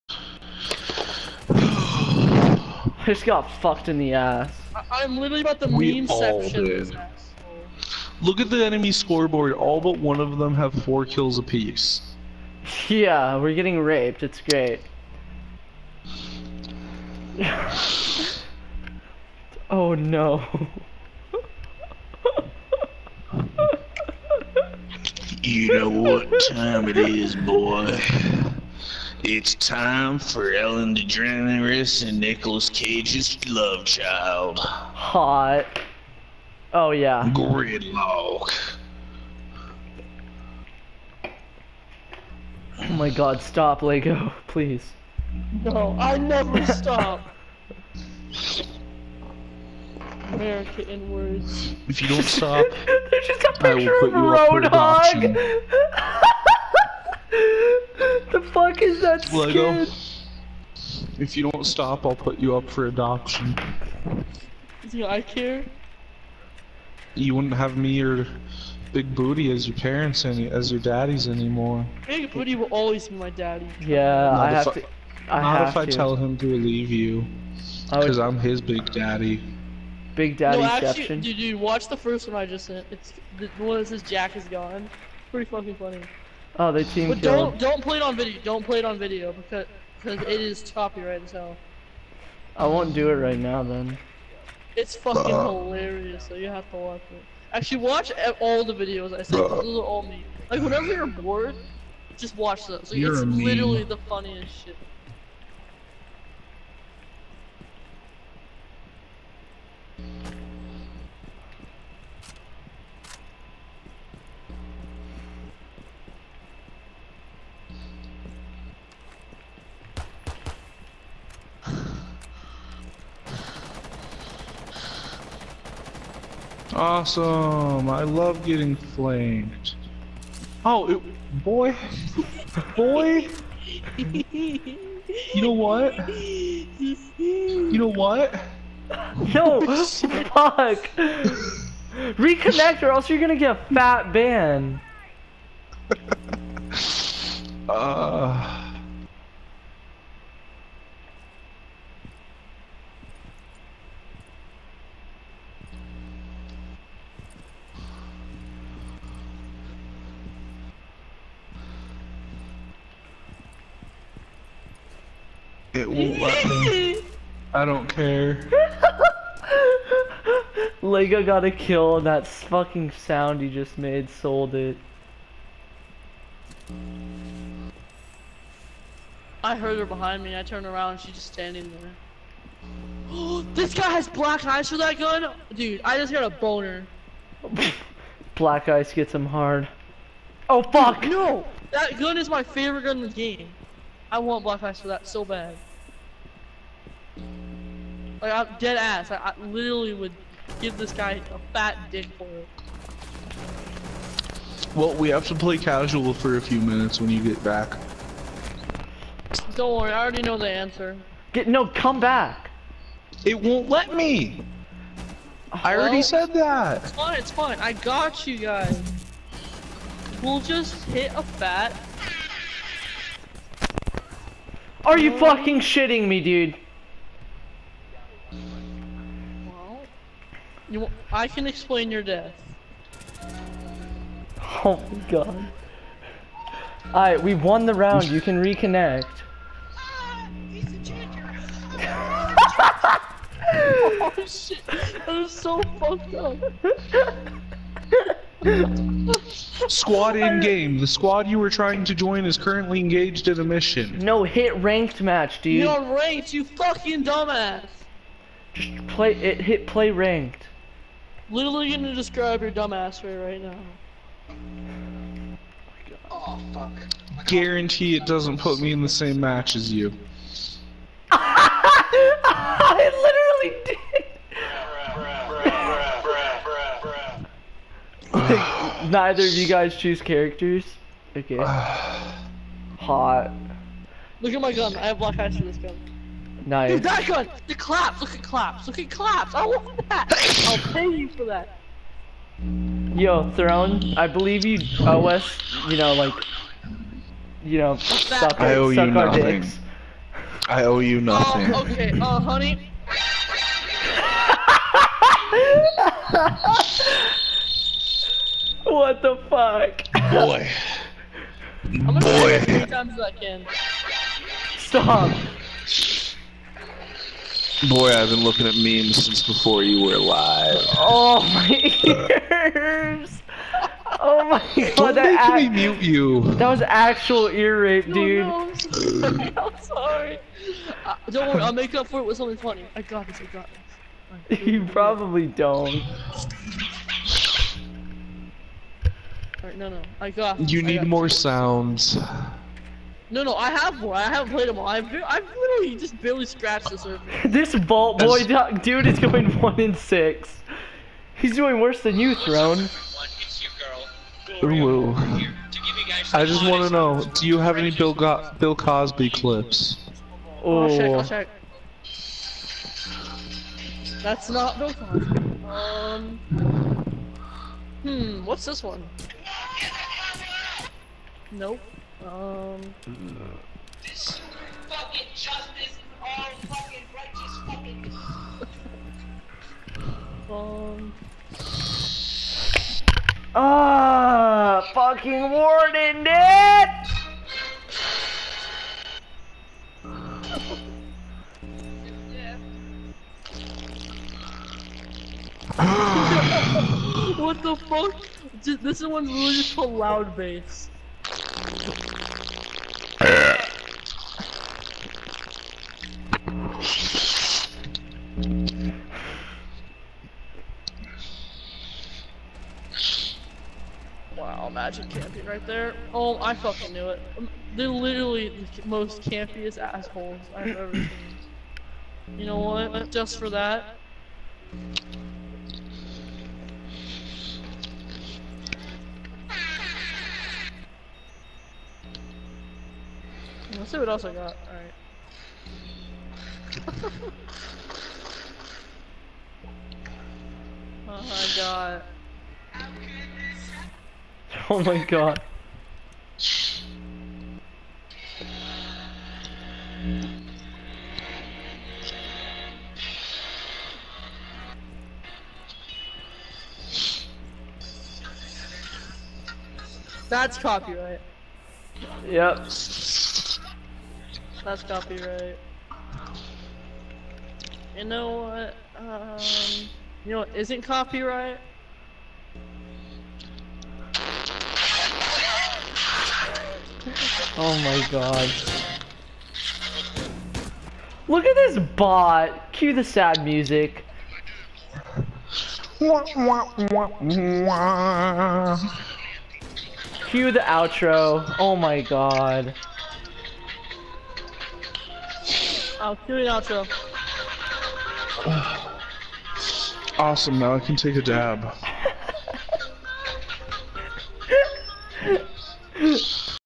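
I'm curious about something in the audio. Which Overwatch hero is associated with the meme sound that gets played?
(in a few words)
Roadhog.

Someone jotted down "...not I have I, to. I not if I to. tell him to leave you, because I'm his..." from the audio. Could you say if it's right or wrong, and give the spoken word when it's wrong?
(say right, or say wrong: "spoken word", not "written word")
right.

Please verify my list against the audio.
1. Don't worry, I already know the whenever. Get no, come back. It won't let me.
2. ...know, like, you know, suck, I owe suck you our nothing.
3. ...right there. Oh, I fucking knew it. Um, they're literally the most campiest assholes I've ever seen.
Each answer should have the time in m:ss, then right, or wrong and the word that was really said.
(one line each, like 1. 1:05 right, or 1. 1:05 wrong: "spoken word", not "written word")
1. 3:29 wrong: "answer", not "whenever"
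2. 4:55 right
3. 6:55 right.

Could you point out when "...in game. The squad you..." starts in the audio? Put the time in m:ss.
4:10.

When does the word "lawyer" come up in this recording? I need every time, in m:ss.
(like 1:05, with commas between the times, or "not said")
not said.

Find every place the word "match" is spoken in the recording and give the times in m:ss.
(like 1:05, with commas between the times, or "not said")
4:15, 4:29.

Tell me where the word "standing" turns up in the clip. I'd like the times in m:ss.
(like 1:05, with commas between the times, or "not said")
3:01.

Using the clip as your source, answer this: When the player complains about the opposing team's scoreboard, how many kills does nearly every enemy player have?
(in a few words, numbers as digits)
4.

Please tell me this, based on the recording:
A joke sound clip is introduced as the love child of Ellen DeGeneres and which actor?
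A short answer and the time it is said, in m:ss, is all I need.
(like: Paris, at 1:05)
Nicolas Cage, at 0:32.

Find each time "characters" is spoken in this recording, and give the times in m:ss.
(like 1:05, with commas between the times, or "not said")
4:40.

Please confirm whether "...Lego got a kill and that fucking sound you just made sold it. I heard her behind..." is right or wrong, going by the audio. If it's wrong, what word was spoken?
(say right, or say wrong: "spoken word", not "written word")
right.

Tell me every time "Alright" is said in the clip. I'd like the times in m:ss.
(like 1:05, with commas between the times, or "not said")
3:56, 7:16.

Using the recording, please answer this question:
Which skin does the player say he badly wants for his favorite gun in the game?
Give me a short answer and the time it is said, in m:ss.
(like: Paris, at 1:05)
Black Flags, at 3:14.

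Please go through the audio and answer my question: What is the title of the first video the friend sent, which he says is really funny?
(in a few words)
Jack is gone.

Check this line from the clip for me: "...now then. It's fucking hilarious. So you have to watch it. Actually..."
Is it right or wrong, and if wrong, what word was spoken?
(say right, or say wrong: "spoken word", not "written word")
right.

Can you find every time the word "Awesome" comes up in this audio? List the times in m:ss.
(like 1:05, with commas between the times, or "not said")
2:06, 8:19.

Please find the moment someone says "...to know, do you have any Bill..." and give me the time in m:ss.
5:56.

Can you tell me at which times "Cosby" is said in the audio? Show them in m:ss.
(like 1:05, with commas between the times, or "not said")
5:58, 6:04.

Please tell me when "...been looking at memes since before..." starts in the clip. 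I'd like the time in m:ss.
5:18.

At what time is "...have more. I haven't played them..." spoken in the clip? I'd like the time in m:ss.
5:43.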